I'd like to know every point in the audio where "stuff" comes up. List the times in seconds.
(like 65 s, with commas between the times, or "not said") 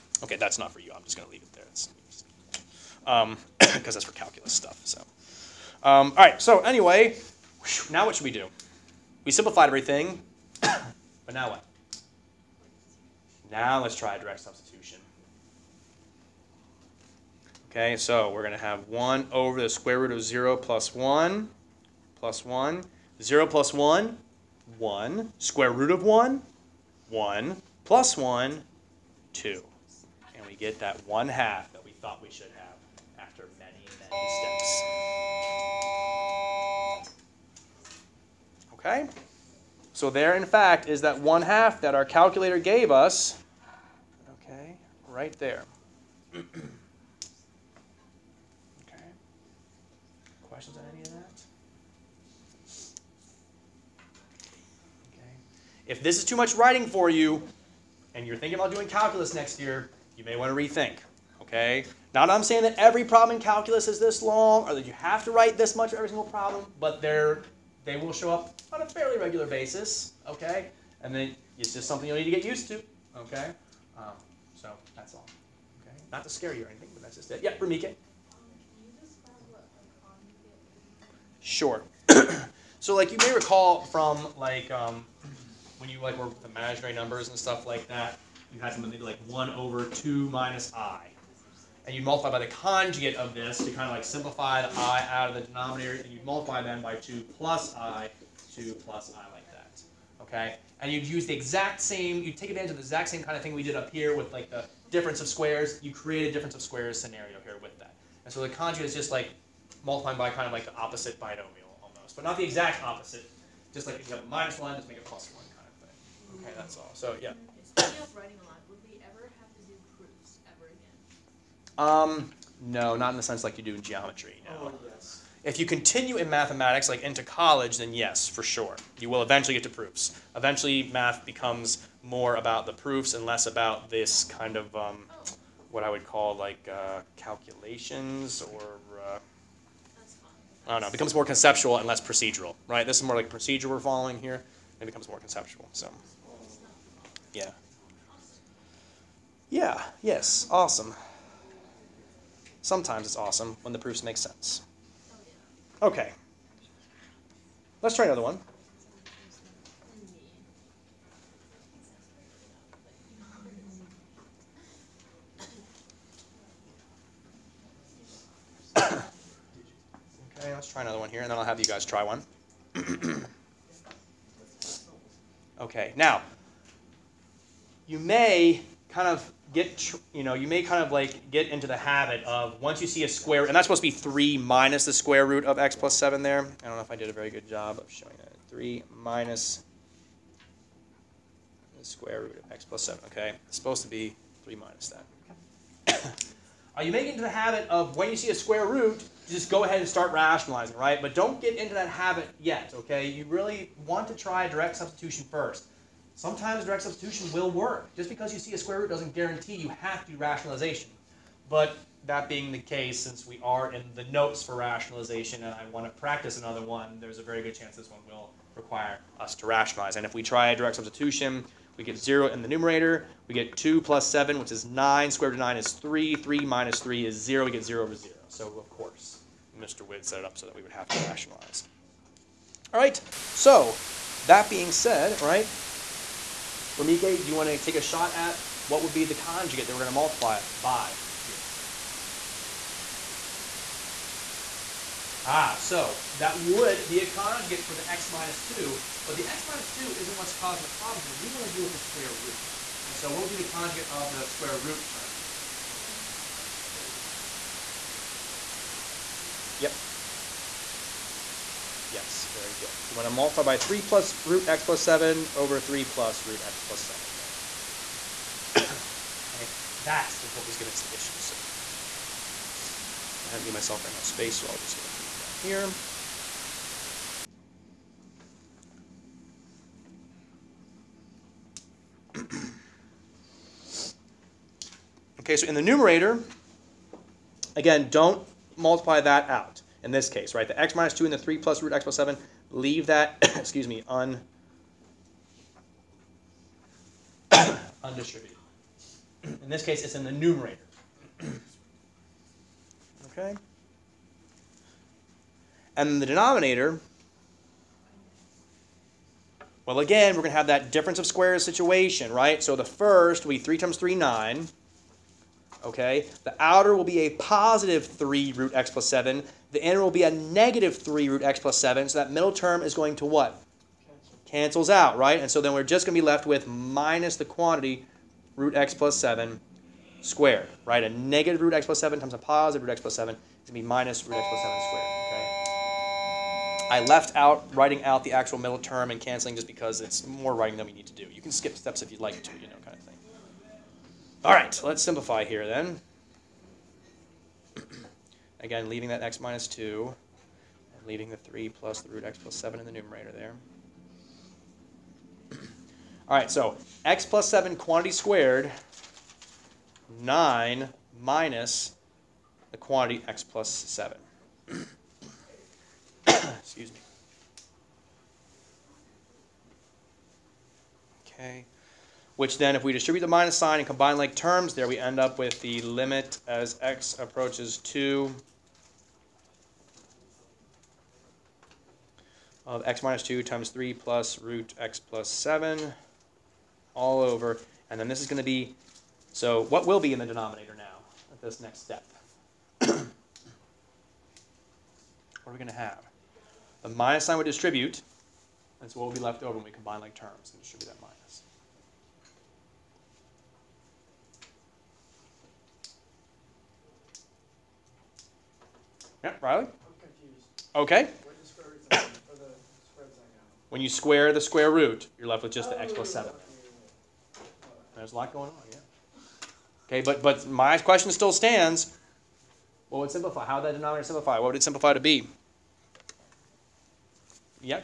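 4 s, 87 s.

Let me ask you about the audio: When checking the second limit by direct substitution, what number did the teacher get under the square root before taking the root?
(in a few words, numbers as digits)
9.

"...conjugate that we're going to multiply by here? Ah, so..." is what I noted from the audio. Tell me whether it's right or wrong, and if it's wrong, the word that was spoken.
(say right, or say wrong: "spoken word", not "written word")
right.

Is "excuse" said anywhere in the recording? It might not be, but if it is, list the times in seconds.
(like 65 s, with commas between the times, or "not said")
293 s, 366 s.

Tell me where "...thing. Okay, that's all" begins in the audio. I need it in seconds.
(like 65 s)
116 s.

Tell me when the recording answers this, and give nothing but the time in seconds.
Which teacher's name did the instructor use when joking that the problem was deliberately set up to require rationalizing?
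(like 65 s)
229 s.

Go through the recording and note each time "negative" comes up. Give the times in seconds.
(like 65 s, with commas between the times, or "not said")
320 s, 330 s.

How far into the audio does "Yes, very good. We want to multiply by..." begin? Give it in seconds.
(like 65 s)
261 s.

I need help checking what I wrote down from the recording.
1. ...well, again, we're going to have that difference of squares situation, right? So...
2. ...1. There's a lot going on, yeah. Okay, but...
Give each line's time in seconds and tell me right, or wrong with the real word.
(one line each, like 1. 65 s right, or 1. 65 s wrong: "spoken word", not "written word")
1. 309 s right
2. 415 s wrong: "7", not "1".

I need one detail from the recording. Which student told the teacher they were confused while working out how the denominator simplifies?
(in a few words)
Riley.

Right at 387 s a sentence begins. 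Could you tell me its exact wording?
And then this is going to be, so what will be in the denominator now at this next step?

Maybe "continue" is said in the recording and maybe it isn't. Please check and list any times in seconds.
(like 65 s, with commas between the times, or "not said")
125 s, 274 s.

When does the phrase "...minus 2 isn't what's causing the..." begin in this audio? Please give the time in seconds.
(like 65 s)
249 s.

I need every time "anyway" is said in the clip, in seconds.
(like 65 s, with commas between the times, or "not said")
6 s.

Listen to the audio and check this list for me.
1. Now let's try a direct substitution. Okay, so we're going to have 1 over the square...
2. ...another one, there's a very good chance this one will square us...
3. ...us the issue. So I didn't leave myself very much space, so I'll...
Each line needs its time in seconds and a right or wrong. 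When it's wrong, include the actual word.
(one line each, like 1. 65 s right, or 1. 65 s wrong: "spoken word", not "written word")
1. 13 s right
2. 216 s wrong: "require", not "square"
3. 270 s right.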